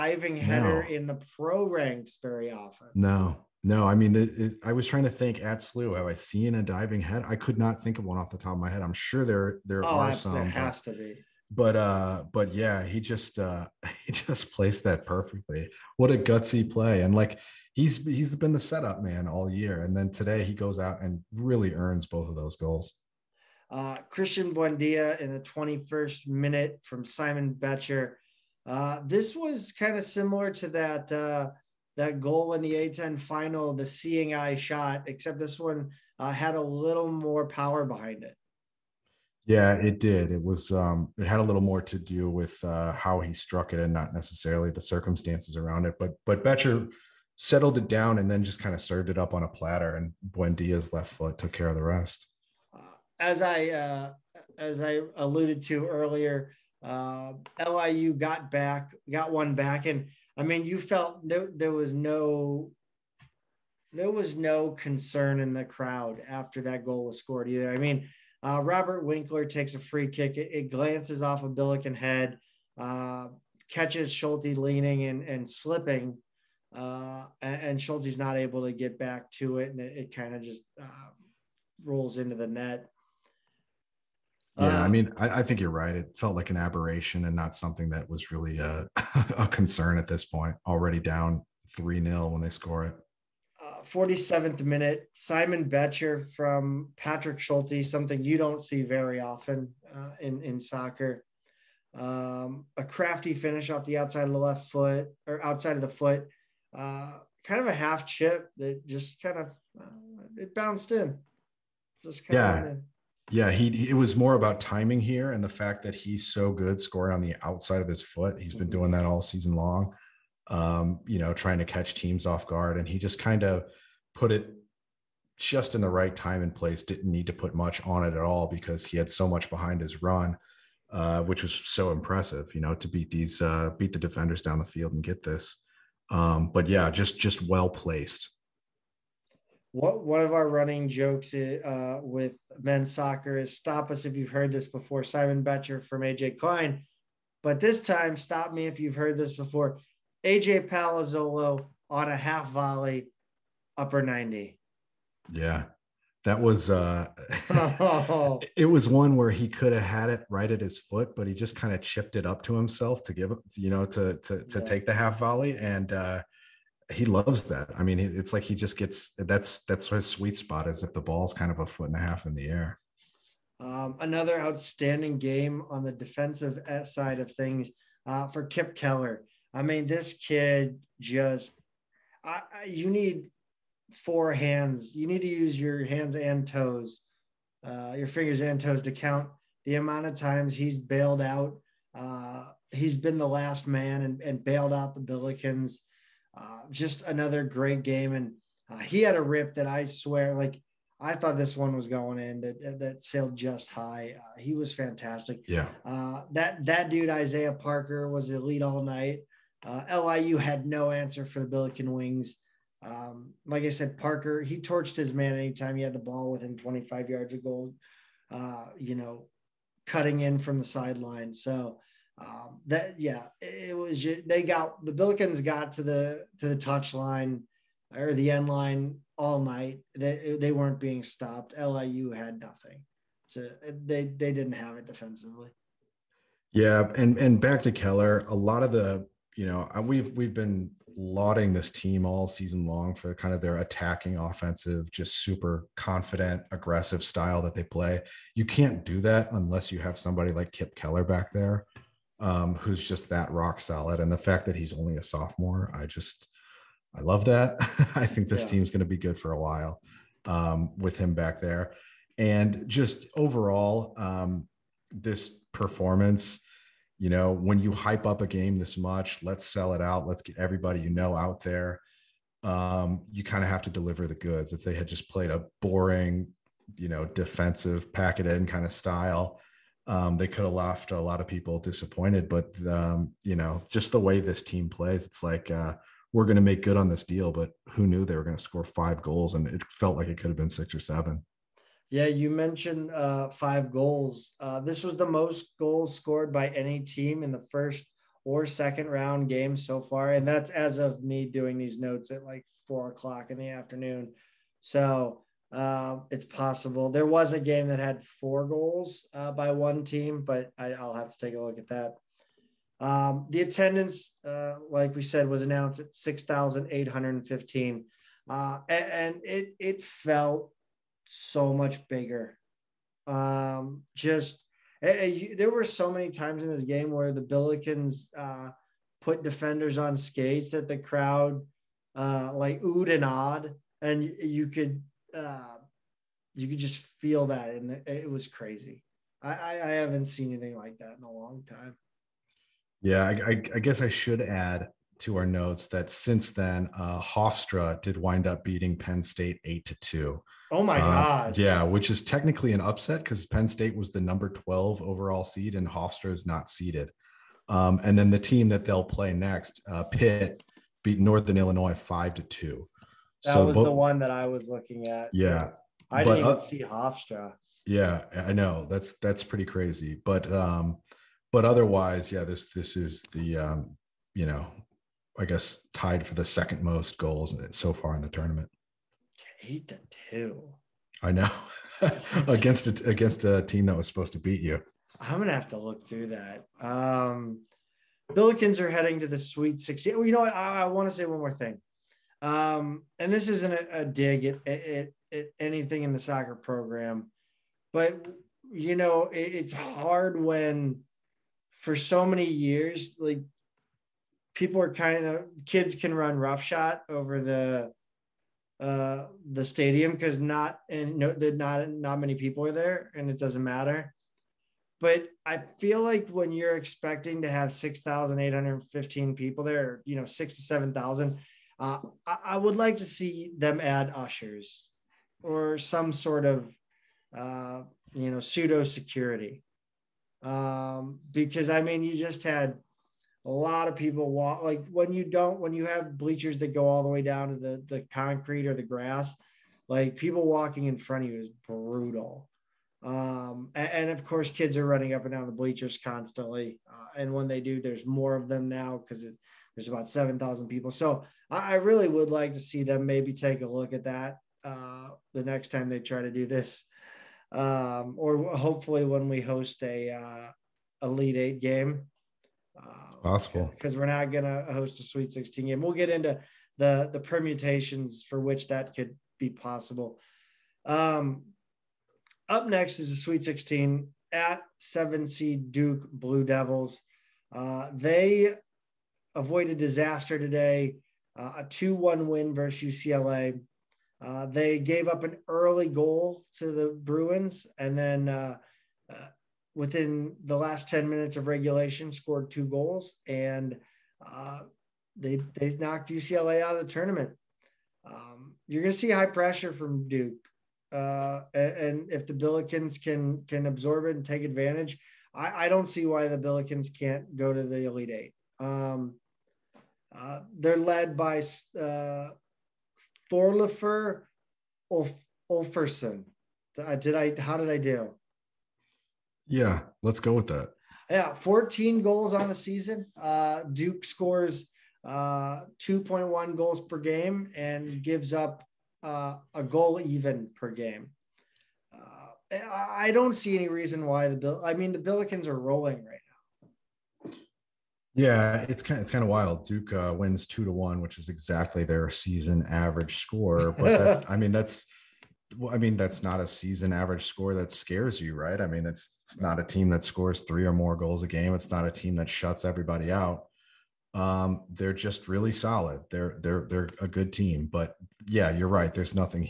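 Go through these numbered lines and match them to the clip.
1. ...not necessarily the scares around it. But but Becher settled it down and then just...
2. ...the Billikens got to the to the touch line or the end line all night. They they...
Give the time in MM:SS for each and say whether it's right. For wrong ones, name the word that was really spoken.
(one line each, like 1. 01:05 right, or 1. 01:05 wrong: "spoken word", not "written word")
1. 00:43 wrong: "circumstances", not "scares"
2. 03:44 right.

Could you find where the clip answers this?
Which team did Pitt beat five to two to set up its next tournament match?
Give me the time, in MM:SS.
06:00.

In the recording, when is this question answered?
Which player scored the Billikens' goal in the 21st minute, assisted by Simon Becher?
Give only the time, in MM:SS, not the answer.
00:24.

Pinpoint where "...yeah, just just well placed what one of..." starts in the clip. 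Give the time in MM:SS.
02:16.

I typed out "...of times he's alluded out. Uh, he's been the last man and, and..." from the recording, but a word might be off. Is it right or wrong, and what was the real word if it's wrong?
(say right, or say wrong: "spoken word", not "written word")
wrong: "bailed", not "alluded".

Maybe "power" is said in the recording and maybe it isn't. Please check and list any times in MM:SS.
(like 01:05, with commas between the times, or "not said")
00:37.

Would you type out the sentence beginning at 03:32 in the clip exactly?
Um, like I said, Parker he torched his man anytime he had the ball within 25 yards of goal.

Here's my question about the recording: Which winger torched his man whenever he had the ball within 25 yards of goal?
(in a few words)
Isaiah Parker.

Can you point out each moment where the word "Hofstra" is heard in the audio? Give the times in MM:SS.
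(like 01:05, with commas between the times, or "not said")
05:47, 05:55, 06:07.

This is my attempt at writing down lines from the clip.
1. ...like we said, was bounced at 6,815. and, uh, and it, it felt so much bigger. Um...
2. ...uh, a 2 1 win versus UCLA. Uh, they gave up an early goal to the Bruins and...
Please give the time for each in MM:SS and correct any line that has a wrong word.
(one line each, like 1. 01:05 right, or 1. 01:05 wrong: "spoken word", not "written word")
1. 05:14 wrong: "announced", not "bounced"
2. 08:01 right.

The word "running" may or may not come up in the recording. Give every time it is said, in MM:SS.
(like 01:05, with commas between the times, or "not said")
02:20, 07:24.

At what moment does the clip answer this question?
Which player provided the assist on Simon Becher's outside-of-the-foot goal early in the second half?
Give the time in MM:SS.
01:36.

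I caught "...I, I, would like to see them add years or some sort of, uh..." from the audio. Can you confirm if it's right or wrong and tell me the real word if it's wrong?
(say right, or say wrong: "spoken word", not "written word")
wrong: "ushers", not "years".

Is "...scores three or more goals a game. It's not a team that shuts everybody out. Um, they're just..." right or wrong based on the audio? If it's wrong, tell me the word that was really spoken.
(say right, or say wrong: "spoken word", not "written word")
right.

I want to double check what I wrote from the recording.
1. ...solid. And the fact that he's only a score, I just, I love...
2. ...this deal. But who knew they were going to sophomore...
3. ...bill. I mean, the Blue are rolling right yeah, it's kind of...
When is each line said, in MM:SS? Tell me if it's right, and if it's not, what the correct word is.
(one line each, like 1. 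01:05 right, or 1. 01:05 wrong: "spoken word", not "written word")
1. 04:13 wrong: "sophomore", not "score"
2. 04:46 wrong: "score", not "sophomore"
3. 08:54 wrong: "Billikens", not "Blue".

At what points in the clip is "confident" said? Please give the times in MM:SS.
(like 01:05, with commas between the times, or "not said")
04:05.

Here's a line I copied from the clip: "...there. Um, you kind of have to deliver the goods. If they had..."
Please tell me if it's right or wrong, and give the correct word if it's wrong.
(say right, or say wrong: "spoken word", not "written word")
right.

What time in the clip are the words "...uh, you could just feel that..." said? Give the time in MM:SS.
05:35.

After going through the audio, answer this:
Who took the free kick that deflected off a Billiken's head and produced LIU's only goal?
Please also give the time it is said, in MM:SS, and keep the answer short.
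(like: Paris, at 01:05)
Robert Winkler, at 01:08.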